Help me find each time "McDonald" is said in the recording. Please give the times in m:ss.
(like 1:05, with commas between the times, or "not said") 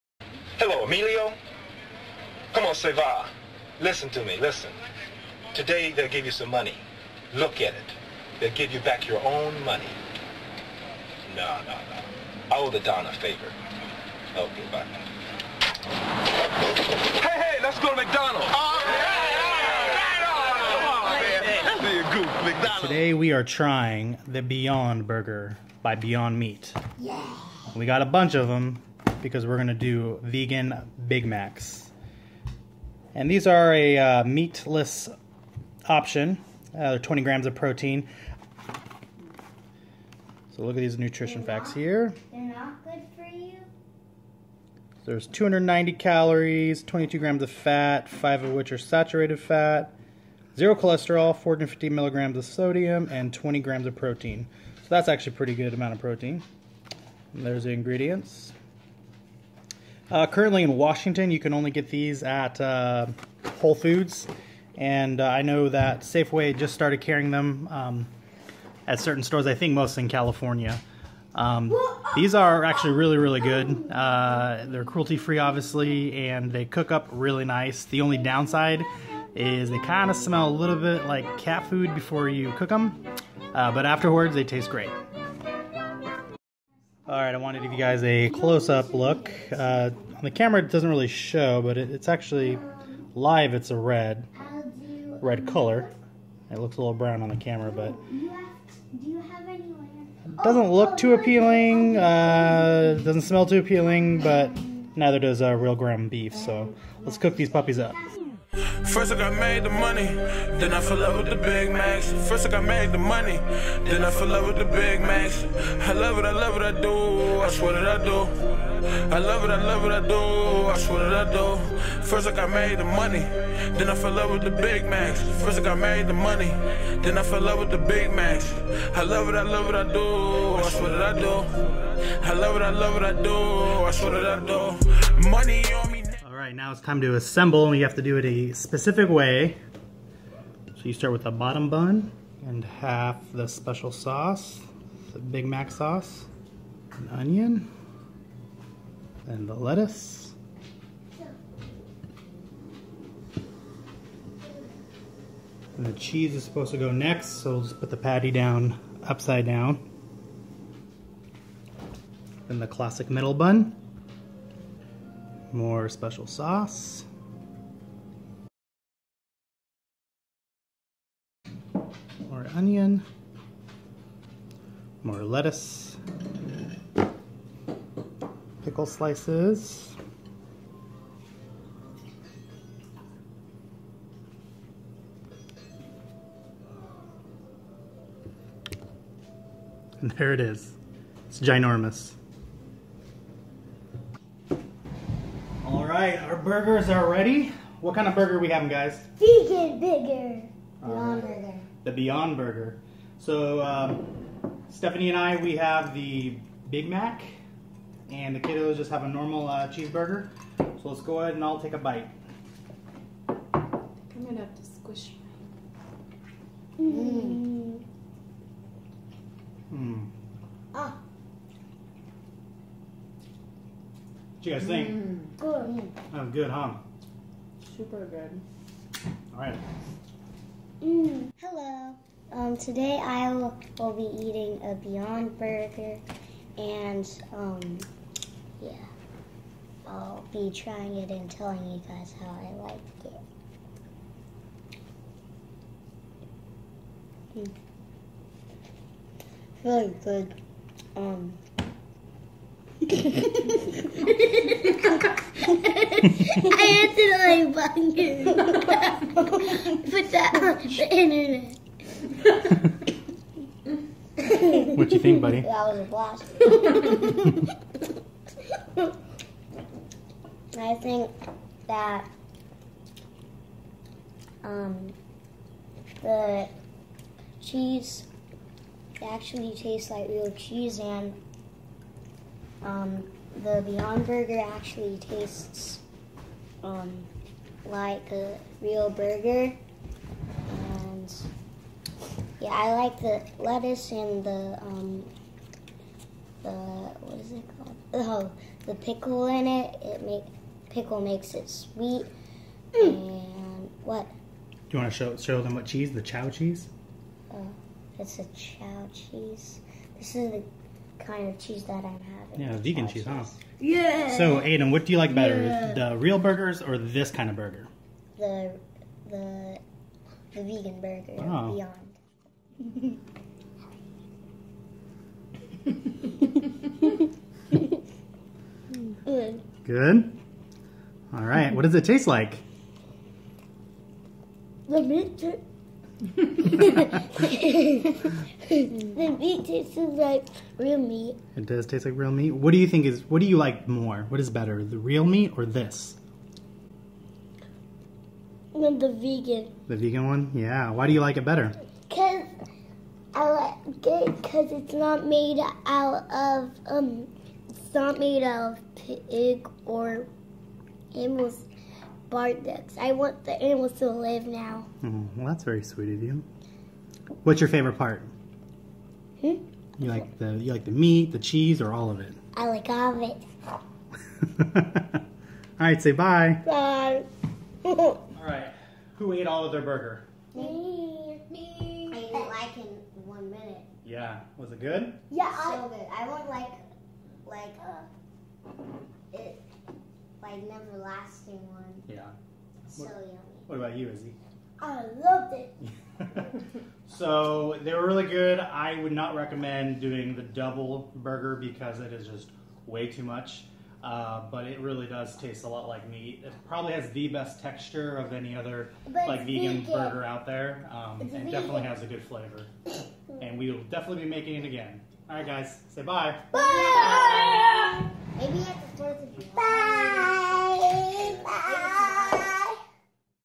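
0:17, 0:22.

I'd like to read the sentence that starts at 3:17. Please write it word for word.
What kind of burger we having, guys?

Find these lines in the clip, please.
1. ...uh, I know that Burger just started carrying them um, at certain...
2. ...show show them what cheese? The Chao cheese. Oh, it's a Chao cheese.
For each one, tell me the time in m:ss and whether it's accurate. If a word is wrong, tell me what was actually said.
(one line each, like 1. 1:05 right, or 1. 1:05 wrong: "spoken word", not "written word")
1. 1:05 wrong: "Safeway", not "Burger"
2. 5:04 right.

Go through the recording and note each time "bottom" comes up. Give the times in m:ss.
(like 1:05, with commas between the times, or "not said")
2:21.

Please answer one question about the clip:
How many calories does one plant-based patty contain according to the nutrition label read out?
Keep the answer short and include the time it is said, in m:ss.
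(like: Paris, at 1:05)
290, at 0:45.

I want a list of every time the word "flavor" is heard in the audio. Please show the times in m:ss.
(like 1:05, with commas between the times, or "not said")
6:52.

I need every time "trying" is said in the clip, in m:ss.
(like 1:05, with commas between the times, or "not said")
0:23, 4:00.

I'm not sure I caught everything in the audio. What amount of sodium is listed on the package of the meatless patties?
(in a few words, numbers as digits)
450 milligrams.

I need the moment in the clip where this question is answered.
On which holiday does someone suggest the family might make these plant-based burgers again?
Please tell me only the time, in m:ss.
6:58.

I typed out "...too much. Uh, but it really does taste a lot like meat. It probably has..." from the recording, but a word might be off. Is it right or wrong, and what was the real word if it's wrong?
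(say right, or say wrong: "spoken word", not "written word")
right.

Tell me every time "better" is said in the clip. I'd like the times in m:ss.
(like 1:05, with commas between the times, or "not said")
5:15, 5:44, 5:51.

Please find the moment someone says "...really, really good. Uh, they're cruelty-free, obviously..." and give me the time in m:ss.
1:12.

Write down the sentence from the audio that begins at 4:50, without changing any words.
And yeah, I like the lettuce and the um, the what is it called?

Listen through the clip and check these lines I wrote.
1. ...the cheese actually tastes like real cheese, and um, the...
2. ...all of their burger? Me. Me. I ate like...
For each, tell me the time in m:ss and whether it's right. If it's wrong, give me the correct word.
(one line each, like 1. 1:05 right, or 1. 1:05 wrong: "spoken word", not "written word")
1. 4:36 right
2. 6:19 right.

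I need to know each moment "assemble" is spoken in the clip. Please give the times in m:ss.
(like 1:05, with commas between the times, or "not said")
2:17.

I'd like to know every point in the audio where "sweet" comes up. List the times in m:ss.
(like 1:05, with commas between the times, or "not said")
5:01, 6:05.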